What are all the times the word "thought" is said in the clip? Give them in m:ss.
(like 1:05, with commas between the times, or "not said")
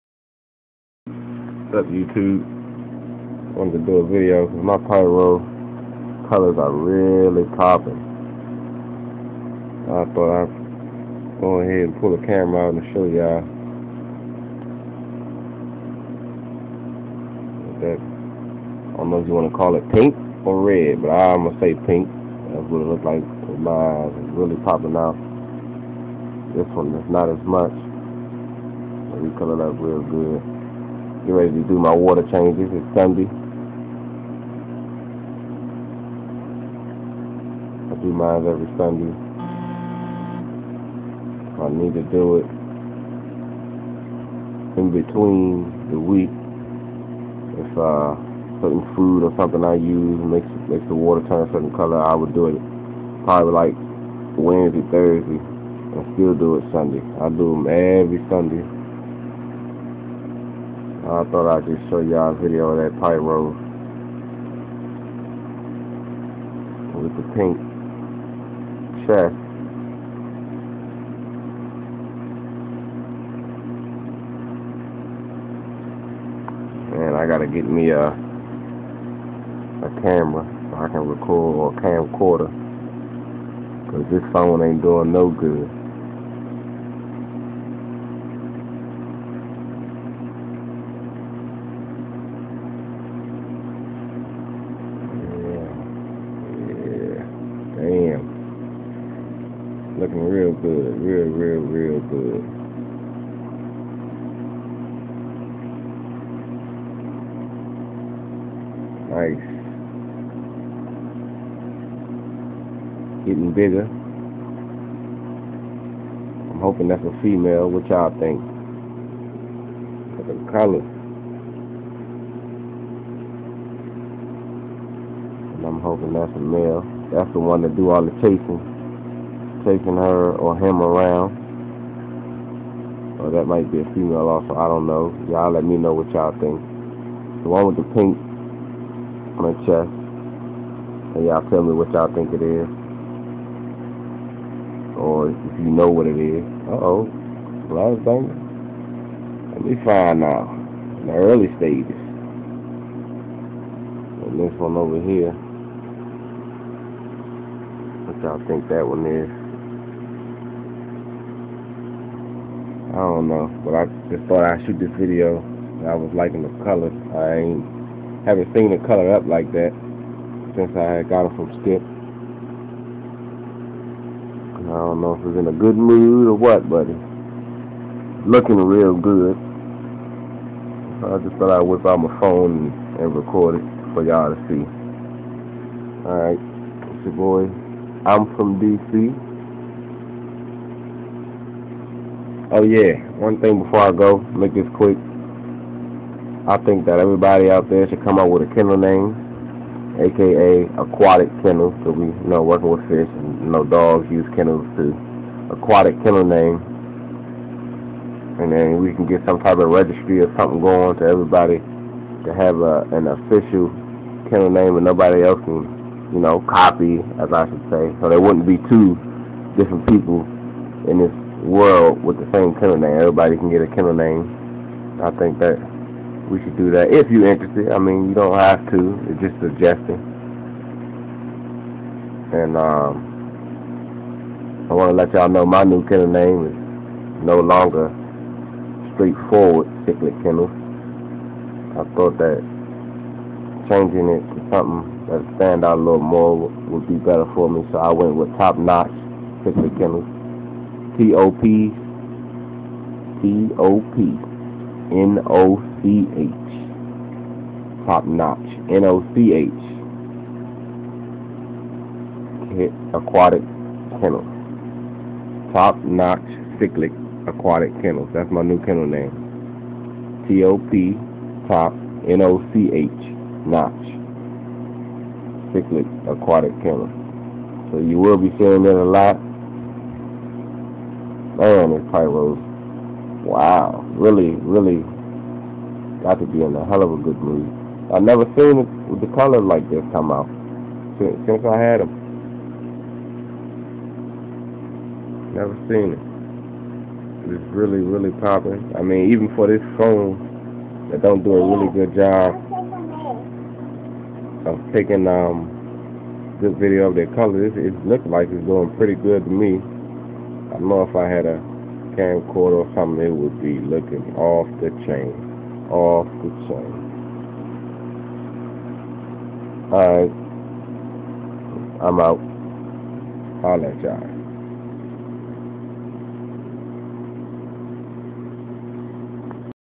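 0:10, 1:01, 2:44, 3:01, 4:01.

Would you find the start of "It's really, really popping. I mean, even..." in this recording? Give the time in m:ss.
4:57.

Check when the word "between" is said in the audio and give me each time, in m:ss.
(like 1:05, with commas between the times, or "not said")
0:44.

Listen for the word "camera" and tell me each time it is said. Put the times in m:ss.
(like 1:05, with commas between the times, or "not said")
0:12, 1:20.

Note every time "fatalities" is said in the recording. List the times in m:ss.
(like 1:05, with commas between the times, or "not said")
not said.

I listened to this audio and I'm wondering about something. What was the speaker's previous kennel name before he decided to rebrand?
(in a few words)
Straightforward cichlid kennel.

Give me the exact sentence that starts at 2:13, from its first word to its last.
Or that might be a female also, I don't know.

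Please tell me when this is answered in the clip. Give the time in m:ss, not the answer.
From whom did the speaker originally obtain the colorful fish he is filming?
2:51.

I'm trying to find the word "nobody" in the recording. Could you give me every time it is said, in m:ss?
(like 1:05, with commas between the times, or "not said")
3:34.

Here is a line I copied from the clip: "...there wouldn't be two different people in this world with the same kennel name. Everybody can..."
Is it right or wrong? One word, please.
right.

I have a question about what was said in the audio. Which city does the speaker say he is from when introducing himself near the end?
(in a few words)
DC.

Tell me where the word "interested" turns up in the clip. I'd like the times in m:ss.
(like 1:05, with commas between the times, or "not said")
3:47.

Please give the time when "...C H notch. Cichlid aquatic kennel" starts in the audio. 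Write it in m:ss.
4:32.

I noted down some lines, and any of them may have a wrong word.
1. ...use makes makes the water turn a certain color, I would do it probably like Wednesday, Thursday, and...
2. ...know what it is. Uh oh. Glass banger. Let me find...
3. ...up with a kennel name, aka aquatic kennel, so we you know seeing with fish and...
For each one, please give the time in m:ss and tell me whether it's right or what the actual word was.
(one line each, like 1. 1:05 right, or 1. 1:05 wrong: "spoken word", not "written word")
1. 0:49 right
2. 2:25 right
3. 3:18 wrong: "working", not "seeing".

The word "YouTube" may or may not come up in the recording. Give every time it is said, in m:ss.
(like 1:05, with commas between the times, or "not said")
0:01.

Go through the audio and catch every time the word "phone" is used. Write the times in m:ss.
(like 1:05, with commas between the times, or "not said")
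1:24, 3:02, 4:59.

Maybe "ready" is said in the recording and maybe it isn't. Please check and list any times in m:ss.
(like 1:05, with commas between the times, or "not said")
0:31.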